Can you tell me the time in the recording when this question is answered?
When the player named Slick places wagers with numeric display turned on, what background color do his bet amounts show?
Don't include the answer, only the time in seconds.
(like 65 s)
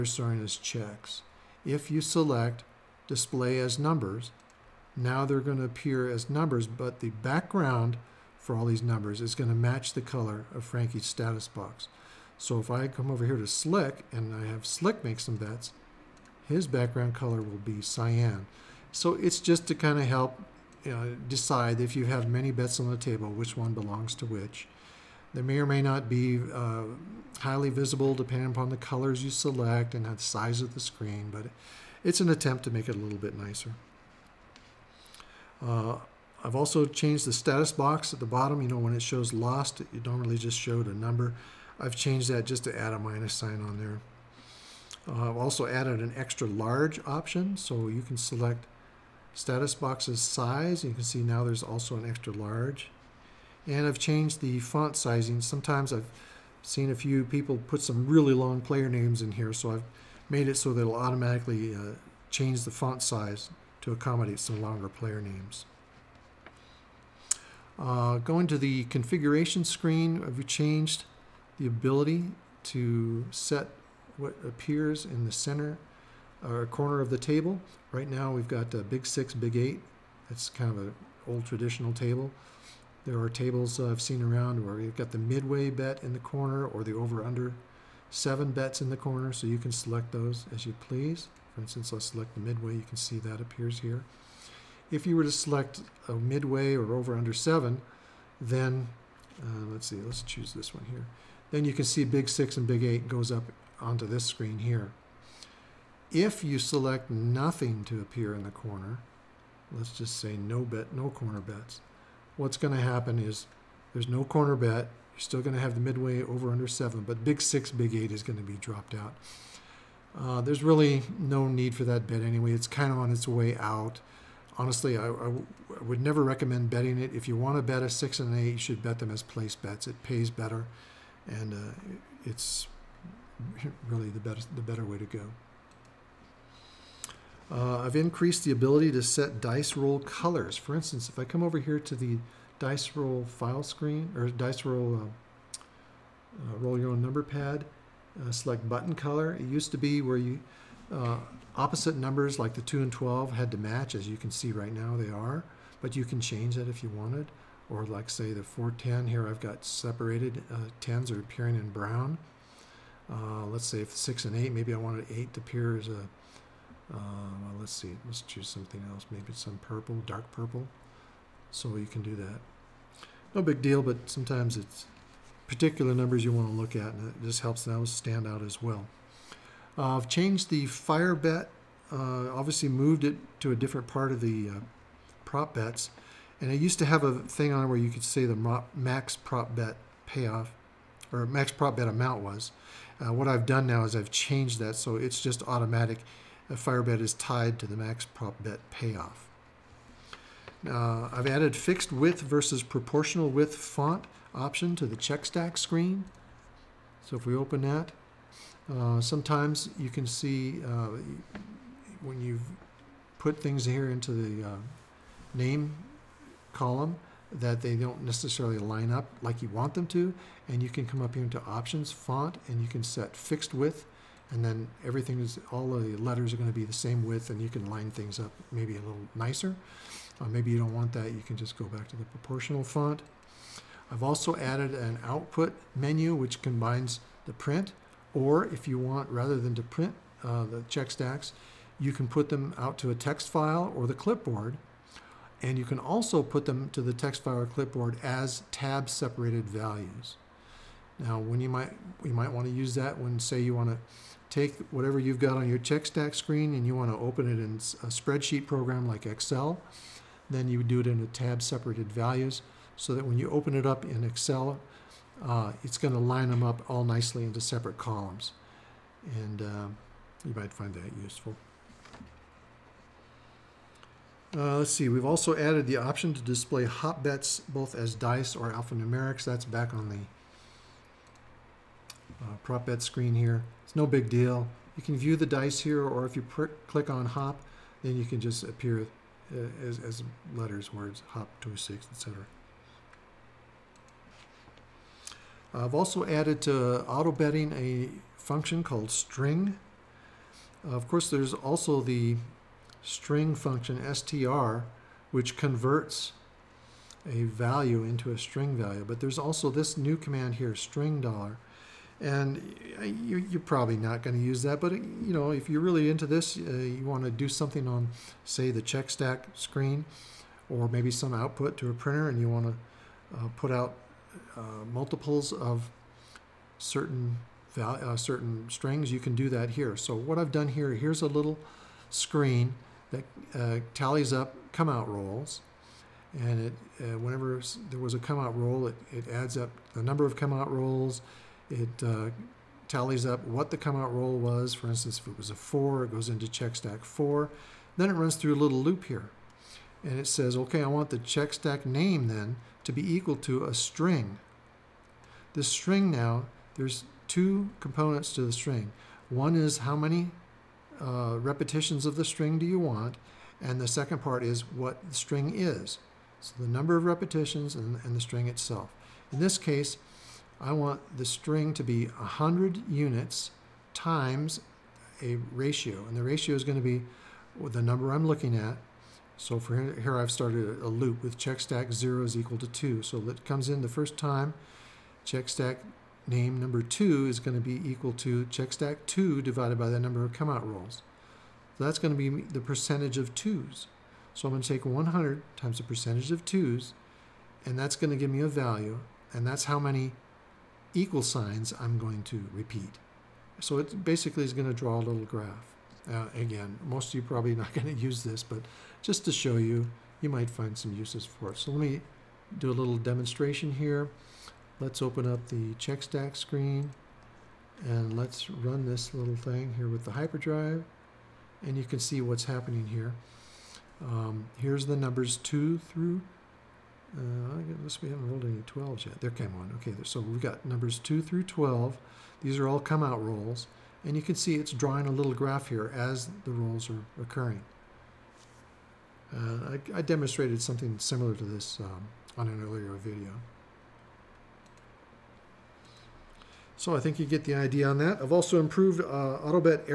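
17 s.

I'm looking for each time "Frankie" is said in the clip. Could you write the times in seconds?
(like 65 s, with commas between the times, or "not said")
10 s.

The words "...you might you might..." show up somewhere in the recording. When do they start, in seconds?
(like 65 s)
251 s.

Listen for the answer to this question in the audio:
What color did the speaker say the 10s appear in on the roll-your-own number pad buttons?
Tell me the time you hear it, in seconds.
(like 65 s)
161 s.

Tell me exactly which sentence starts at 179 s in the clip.
Uh, I've changed the fire bet, uh, obviously moved it to a different part of the uh, prop bets.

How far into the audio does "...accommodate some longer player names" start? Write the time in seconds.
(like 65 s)
63 s.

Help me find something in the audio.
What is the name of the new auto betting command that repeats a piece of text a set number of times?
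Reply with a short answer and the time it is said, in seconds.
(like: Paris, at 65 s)
string dollar, at 310 s.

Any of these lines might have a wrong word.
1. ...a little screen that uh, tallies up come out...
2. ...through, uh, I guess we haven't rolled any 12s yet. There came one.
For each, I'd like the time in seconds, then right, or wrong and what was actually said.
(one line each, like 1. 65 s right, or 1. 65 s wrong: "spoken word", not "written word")
1. 331 s right
2. 425 s right.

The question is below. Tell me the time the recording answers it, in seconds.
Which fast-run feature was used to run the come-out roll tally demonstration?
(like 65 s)
419 s.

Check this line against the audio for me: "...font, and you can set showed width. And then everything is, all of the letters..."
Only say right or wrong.
wrong.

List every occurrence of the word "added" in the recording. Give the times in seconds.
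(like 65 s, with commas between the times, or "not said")
45 s, 201 s, 234 s, 275 s, 296 s.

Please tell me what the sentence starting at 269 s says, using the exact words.
And uh, you might find that useful.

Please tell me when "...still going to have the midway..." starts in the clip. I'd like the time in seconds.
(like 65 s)
115 s.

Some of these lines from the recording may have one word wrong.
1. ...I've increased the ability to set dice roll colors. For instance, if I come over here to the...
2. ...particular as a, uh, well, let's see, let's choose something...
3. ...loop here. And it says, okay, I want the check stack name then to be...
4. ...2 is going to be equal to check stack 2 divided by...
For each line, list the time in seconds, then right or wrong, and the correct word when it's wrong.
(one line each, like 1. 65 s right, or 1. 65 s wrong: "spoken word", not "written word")
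1. 137 s right
2. 165 s wrong: "appear", not "particular"
3. 348 s right
4. 386 s right.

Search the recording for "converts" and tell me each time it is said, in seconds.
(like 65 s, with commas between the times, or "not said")
305 s.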